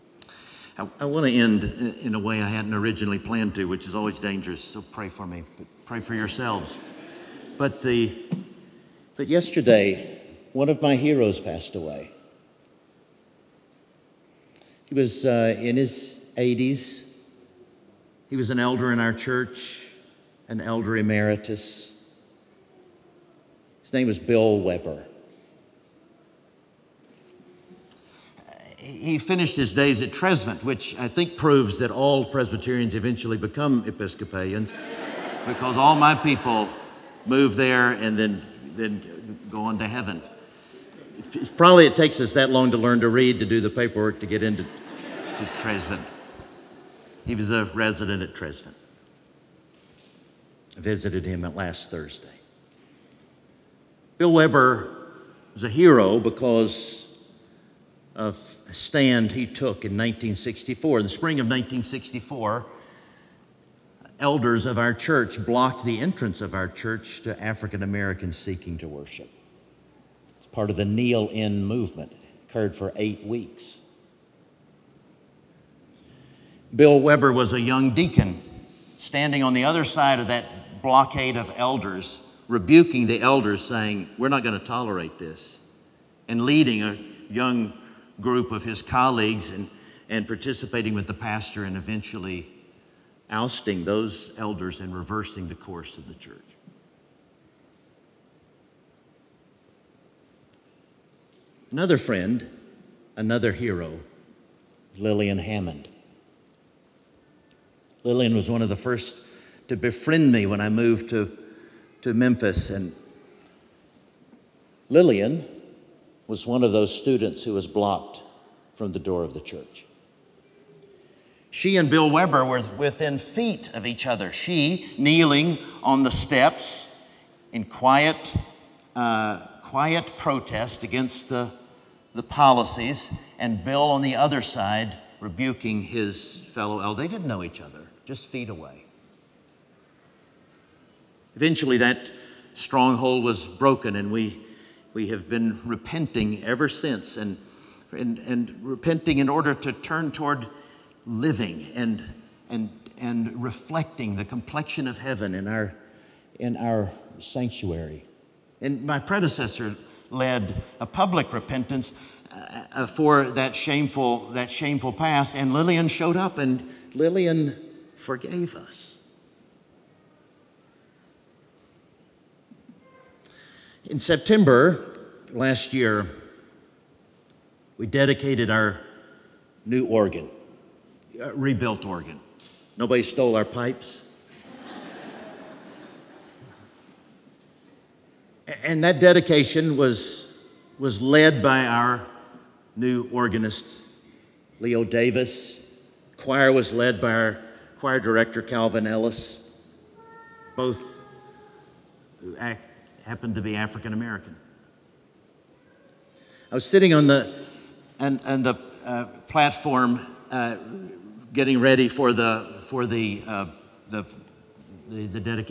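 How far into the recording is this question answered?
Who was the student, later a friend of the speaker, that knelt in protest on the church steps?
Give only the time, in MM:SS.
01:44.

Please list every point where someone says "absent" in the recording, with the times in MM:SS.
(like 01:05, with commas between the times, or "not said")
not said.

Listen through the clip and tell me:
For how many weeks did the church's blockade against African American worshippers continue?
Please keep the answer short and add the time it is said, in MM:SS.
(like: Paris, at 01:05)
8, at 01:12.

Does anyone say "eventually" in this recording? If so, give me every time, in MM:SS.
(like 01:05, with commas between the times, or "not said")
00:32, 01:31, 02:21.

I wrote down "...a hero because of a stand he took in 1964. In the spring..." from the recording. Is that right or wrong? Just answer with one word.
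right.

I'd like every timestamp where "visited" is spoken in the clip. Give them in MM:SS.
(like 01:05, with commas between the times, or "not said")
00:50.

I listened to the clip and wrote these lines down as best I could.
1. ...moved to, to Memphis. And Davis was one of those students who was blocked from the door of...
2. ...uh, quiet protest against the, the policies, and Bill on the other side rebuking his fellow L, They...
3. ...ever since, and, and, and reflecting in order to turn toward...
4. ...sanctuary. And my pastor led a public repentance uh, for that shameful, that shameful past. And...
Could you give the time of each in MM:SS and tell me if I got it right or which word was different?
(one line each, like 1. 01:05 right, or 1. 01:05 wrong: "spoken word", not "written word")
1. 01:50 wrong: "Lillian", not "Davis"
2. 02:08 right
3. 02:26 wrong: "repenting", not "reflecting"
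4. 02:37 wrong: "predecessor", not "pastor".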